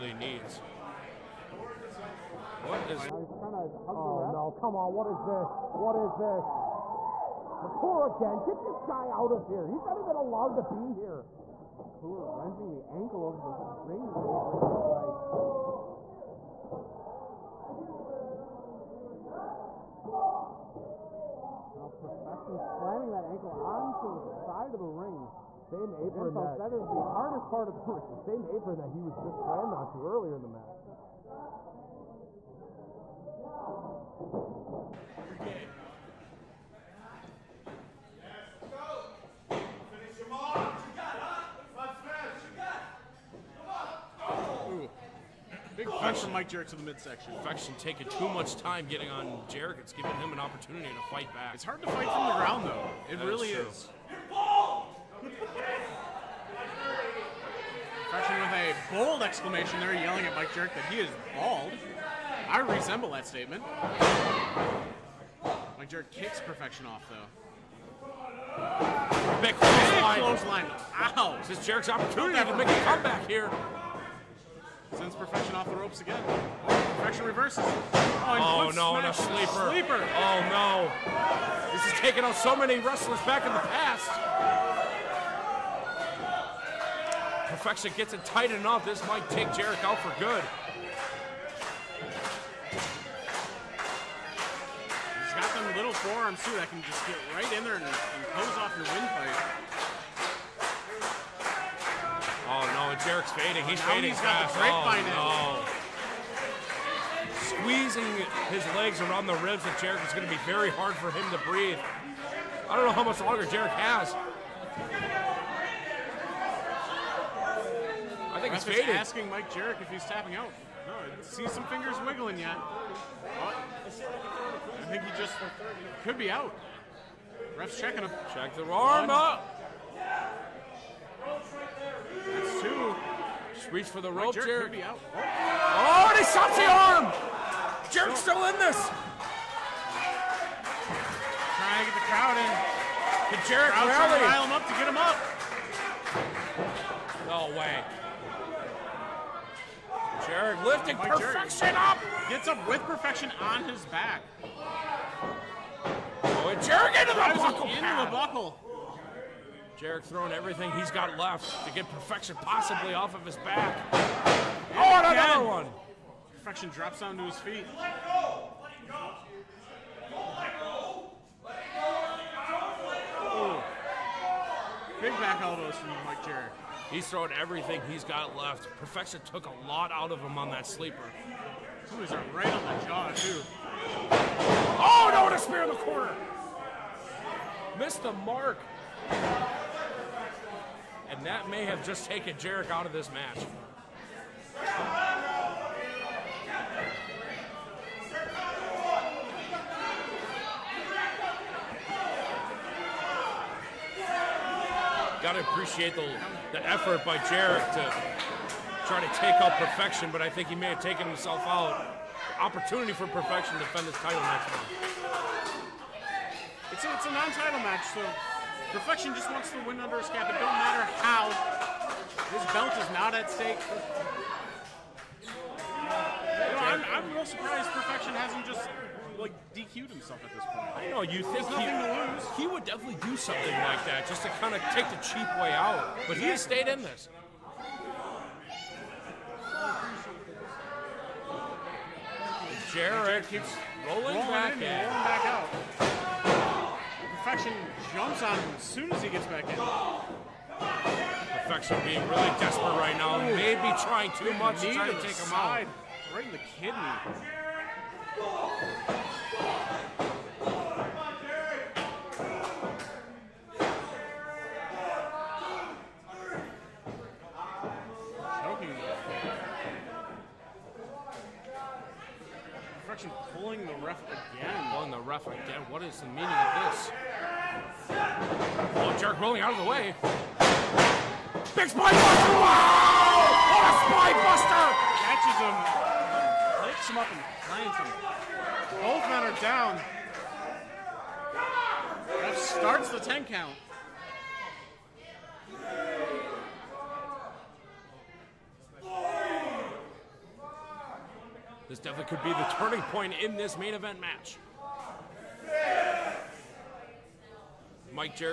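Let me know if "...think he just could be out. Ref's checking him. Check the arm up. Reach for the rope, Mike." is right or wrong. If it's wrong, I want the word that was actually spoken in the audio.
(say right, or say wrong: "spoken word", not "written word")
wrong: "Jerk", not "Mike".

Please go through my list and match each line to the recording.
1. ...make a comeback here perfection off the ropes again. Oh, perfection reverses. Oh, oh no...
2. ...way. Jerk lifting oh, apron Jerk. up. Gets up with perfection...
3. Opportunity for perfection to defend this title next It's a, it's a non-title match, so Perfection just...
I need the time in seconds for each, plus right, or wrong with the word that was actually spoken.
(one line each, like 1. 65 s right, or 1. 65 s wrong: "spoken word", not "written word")
1. 72 s right
2. 147 s wrong: "perfection", not "apron"
3. 212 s right.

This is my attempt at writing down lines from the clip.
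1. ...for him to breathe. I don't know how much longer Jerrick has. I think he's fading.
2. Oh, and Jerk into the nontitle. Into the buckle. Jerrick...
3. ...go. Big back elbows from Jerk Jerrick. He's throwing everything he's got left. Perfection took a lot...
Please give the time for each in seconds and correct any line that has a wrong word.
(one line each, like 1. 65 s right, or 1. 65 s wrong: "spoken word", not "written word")
1. 110 s right
2. 156 s wrong: "buckle", not "nontitle"
3. 170 s wrong: "Mike", not "Jerk".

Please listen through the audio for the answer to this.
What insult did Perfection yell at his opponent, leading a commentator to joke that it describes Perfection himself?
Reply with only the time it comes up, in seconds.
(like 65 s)
61 s.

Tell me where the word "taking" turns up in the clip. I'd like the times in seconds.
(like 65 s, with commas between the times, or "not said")
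47 s, 81 s.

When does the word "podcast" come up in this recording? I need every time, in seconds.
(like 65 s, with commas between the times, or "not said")
not said.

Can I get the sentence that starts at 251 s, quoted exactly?
Perfection being really desperate right now.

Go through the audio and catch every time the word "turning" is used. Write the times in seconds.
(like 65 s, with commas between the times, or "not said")
302 s.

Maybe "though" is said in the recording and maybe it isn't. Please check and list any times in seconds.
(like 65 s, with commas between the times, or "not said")
52 s, 67 s.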